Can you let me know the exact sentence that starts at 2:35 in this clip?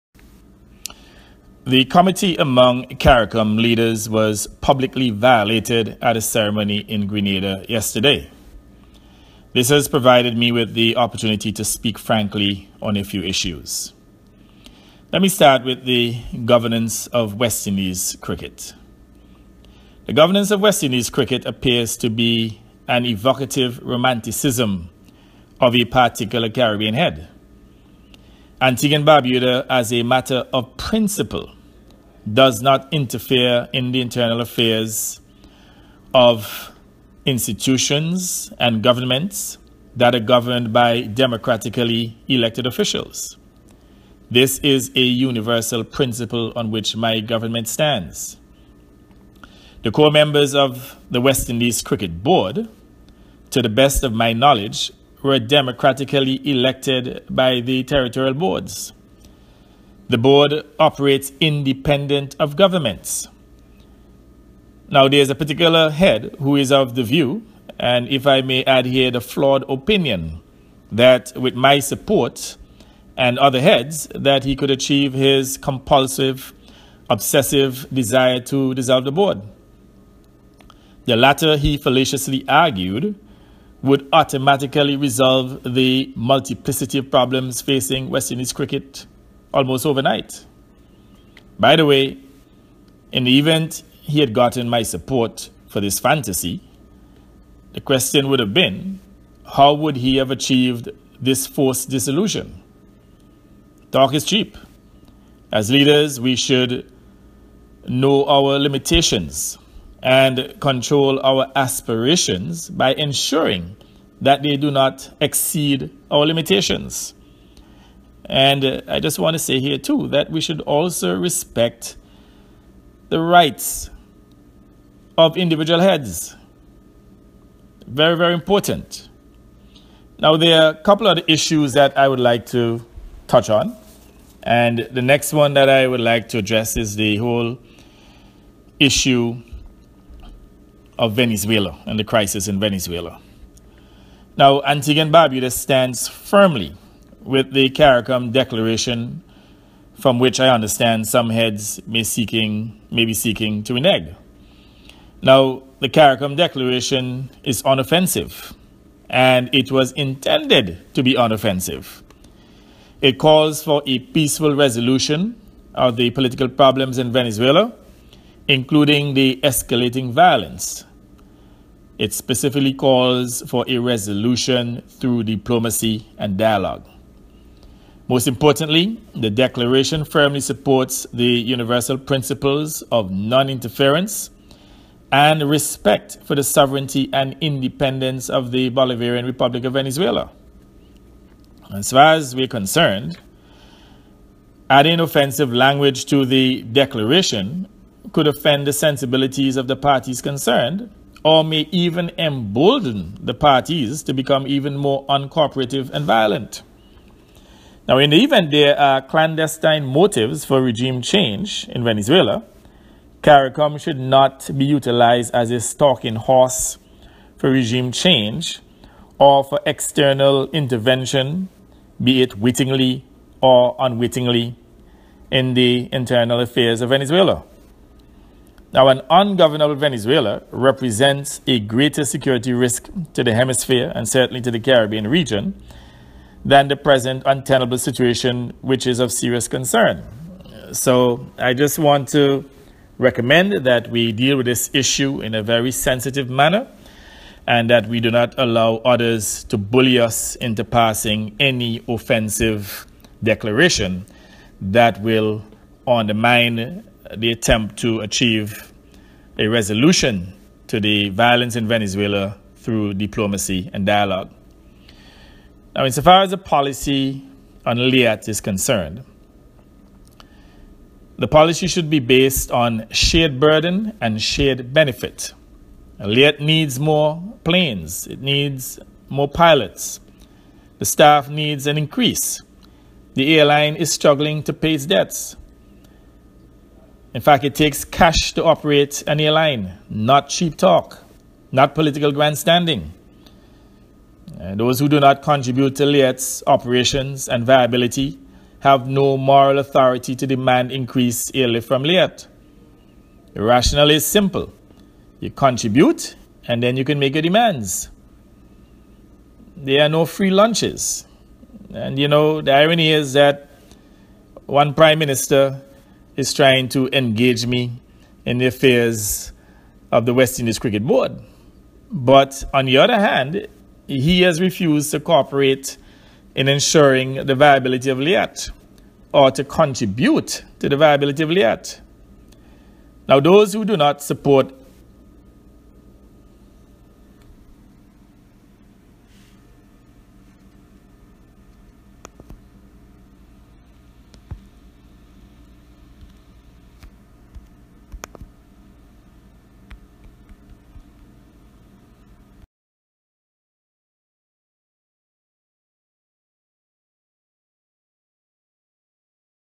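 Now, the CARICOM declaration is unoffensive, and it was intended to be unoffensive.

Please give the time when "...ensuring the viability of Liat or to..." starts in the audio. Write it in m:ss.
5:26.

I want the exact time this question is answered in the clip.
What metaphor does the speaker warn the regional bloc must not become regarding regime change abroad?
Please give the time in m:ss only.
3:35.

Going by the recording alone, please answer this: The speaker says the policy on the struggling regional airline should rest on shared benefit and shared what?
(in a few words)
burden.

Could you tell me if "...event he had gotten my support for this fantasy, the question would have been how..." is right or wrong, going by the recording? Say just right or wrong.
right.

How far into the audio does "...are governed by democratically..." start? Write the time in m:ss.
0:40.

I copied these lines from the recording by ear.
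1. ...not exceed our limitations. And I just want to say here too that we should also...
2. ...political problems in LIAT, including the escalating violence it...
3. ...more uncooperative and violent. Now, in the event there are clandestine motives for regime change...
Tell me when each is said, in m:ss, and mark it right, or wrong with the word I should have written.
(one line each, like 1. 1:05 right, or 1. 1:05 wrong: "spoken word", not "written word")
1. 1:54 right
2. 2:46 wrong: "Venezuela", not "LIAT"
3. 3:24 right.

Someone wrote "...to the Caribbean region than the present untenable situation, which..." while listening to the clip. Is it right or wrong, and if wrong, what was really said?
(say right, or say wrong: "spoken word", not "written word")
right.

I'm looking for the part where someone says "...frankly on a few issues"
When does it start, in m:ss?
0:11.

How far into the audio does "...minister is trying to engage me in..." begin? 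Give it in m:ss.
5:14.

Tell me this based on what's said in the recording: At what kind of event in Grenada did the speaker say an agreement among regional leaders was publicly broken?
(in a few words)
a ceremony.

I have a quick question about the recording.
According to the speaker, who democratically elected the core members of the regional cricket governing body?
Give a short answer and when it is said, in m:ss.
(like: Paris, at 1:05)
the territorial boards, at 0:57.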